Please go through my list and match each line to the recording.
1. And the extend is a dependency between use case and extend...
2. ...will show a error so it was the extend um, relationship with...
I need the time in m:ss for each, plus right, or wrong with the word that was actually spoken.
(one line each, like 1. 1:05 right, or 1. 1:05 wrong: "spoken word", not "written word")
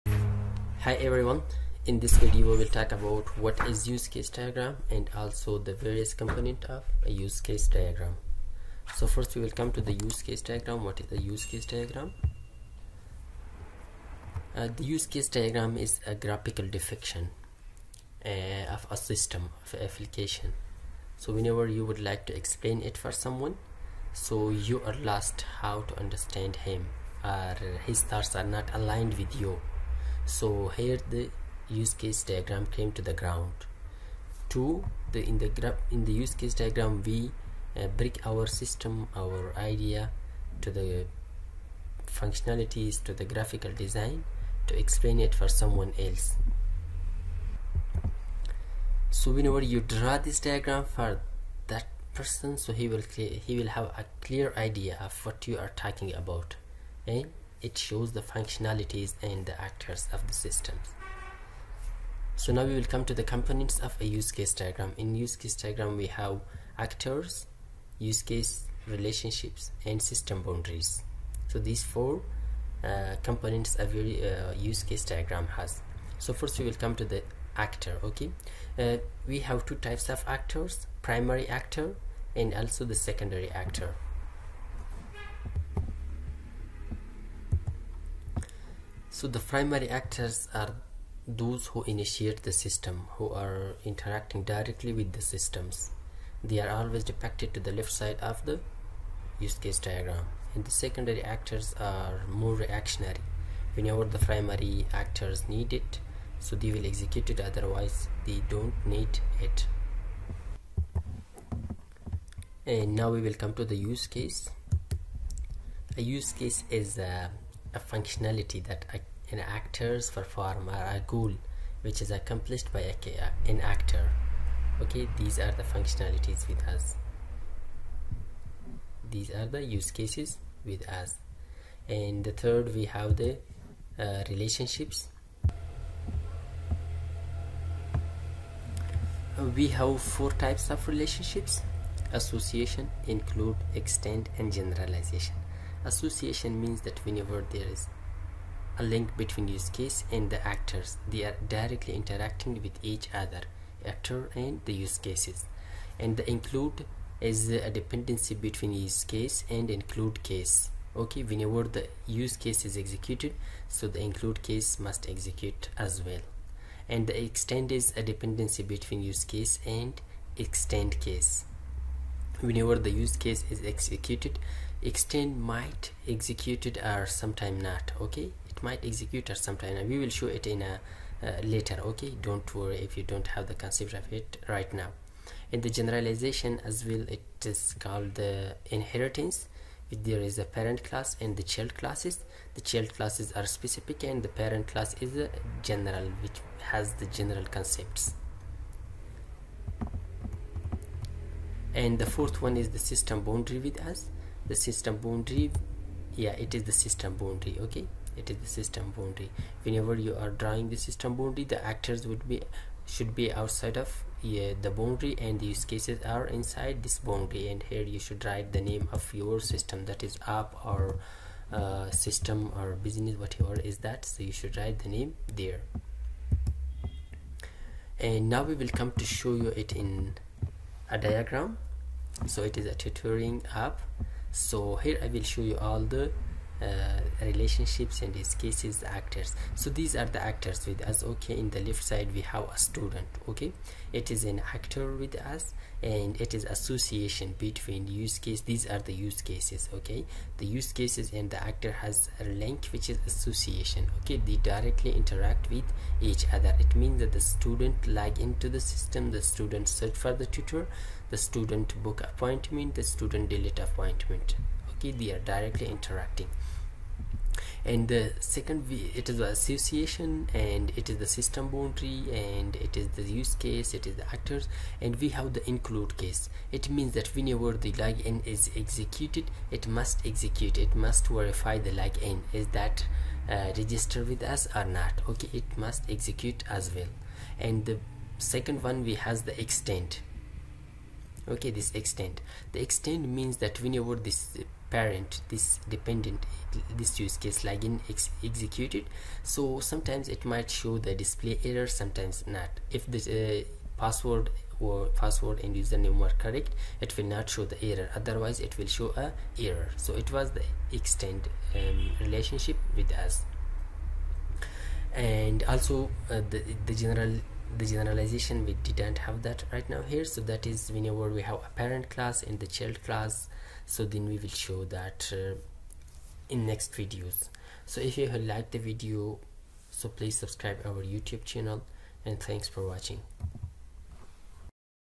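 1. 2:46 right
2. 5:08 right.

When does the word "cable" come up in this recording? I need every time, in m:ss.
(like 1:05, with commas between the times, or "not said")
not said.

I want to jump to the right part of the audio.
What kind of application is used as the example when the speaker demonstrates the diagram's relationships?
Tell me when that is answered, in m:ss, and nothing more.
3:52.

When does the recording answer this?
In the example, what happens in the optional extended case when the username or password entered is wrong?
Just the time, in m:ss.
5:00.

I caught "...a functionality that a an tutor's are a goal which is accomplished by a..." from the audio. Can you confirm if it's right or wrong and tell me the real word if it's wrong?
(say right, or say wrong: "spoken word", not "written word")
wrong: "actor", not "tutor".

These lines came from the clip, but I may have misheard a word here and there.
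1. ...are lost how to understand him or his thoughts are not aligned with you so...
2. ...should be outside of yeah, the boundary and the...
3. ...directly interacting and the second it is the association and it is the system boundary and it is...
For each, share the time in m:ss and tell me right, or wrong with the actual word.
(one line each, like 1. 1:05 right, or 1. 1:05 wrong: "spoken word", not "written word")
1. 0:24 right
2. 3:32 right
3. 4:25 right.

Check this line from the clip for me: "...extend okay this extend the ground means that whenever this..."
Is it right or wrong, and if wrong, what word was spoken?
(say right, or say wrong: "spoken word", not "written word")
wrong: "extend", not "ground".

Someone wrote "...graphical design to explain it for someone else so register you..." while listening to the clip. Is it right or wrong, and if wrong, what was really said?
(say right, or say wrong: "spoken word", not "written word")
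wrong: "whenever", not "register".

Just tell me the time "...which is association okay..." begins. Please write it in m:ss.
4:12.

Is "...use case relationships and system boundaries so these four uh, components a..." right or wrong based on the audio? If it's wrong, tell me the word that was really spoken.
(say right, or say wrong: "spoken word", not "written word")
right.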